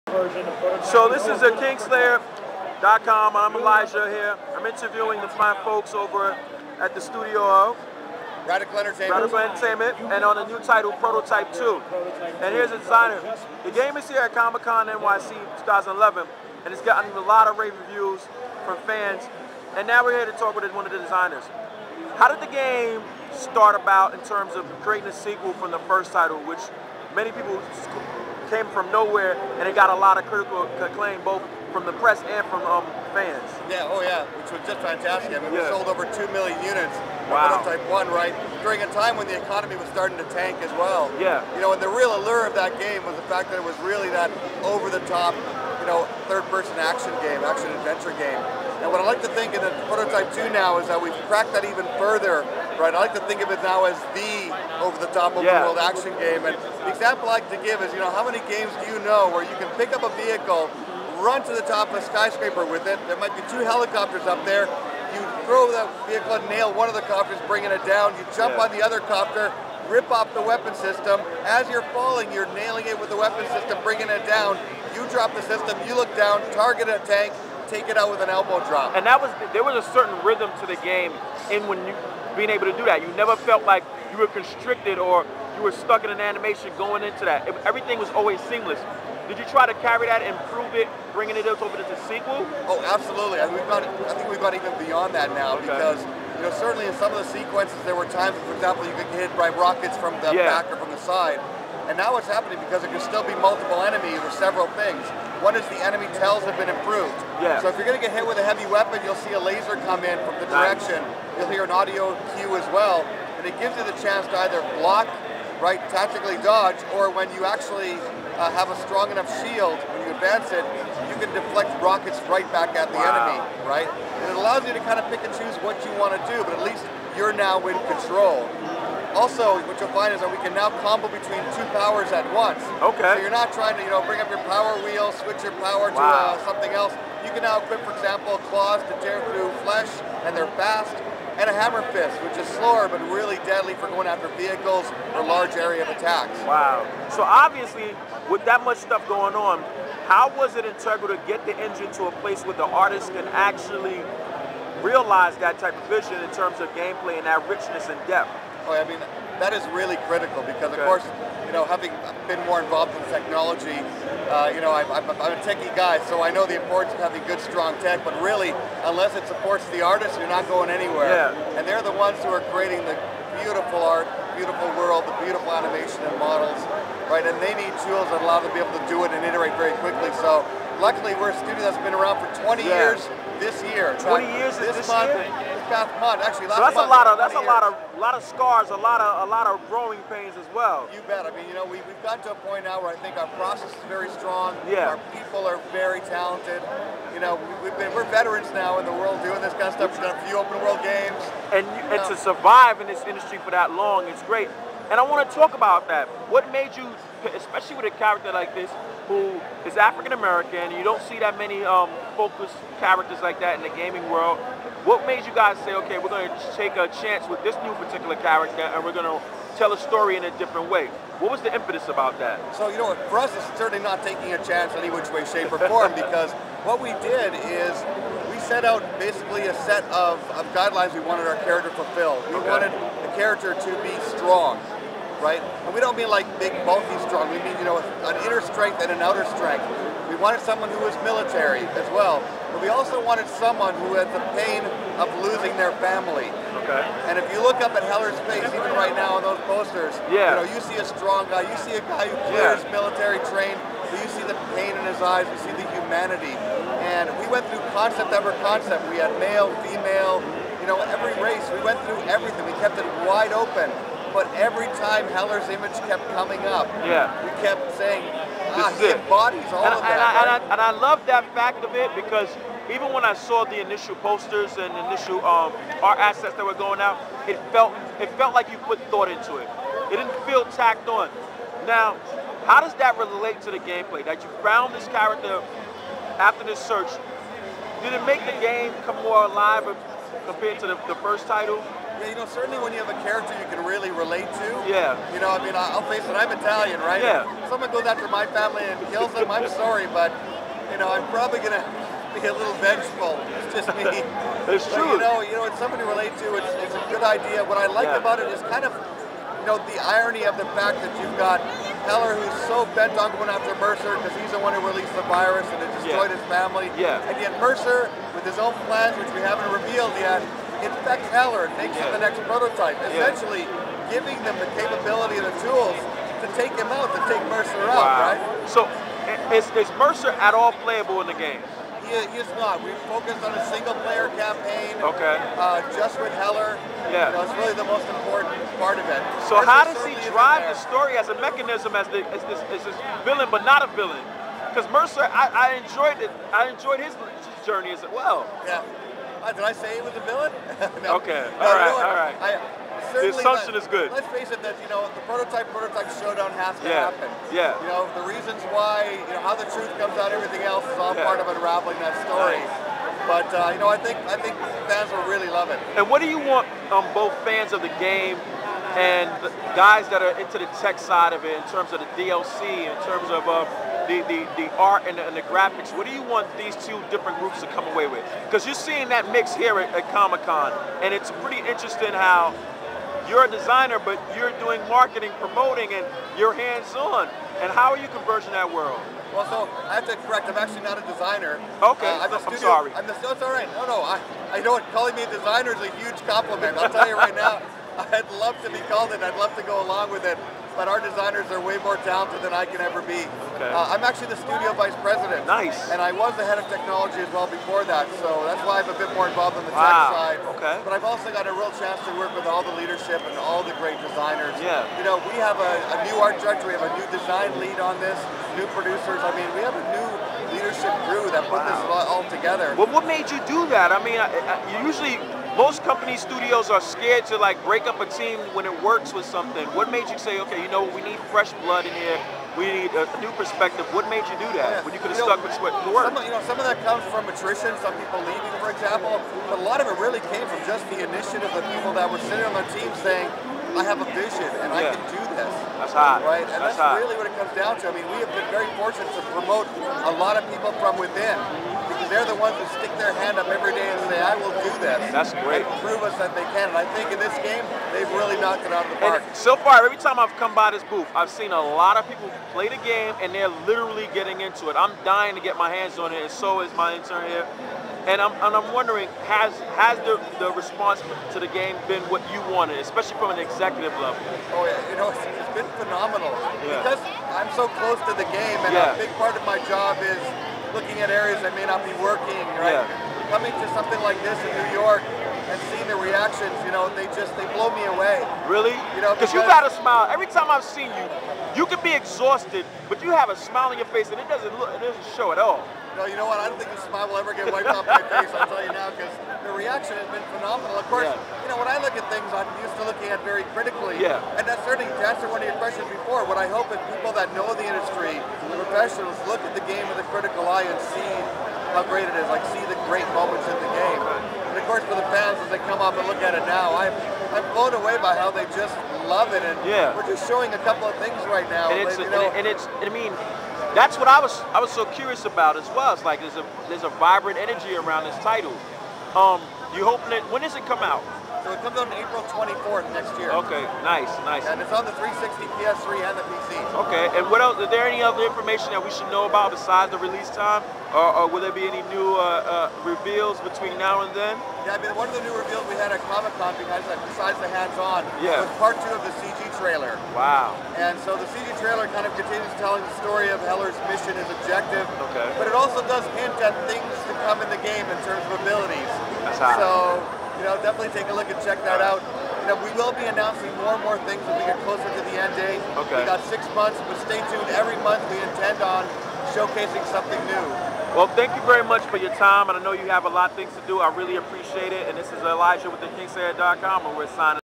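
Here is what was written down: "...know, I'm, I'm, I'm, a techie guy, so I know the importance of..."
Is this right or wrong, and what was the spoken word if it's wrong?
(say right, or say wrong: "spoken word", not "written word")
right.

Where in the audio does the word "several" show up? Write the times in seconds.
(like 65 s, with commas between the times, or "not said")
104 s.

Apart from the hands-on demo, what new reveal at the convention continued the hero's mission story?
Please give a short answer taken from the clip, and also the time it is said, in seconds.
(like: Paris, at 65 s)
part two of the CG trailer, at 548 s.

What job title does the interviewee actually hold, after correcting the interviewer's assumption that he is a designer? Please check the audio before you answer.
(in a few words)
studio vice president.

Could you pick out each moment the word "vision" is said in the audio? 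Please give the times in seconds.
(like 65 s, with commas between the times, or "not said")
155 s, 443 s.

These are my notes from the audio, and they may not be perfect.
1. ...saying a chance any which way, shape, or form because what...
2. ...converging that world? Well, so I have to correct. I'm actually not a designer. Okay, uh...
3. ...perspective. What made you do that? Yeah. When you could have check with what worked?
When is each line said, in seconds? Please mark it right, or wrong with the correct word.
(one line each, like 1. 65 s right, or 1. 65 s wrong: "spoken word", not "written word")
1. 224 s wrong: "taking", not "saying"
2. 387 s right
3. 433 s wrong: "stuck", not "check".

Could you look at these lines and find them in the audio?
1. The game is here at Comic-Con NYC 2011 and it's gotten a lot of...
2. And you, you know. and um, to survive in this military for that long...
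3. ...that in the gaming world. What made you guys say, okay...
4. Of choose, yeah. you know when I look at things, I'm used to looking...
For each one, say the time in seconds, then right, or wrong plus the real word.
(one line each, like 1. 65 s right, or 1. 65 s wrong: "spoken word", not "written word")
1. 13 s right
2. 201 s wrong: "industry", not "military"
3. 213 s right
4. 500 s wrong: "course", not "choose".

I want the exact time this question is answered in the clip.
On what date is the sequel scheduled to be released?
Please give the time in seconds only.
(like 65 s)
531 s.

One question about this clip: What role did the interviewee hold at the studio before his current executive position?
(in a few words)
head of technology.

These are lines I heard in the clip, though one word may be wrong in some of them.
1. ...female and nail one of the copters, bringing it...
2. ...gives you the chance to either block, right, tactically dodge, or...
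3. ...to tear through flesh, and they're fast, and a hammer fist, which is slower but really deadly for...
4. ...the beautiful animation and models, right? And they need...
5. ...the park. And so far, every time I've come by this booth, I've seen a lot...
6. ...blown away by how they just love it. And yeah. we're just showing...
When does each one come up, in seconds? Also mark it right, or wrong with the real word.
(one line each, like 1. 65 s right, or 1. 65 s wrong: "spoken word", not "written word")
1. 66 s wrong: "vehicle", not "female"
2. 113 s right
3. 138 s right
4. 175 s right
5. 458 s right
6. 517 s right.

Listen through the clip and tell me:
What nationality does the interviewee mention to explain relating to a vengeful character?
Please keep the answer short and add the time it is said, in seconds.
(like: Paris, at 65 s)
Italian, at 296 s.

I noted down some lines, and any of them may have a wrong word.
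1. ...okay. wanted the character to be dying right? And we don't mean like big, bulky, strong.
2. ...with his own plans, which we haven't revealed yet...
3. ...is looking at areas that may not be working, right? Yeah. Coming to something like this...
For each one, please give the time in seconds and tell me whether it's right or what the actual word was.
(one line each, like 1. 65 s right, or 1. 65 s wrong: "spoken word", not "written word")
1. 232 s wrong: "strong", not "dying"
2. 318 s right
3. 479 s right.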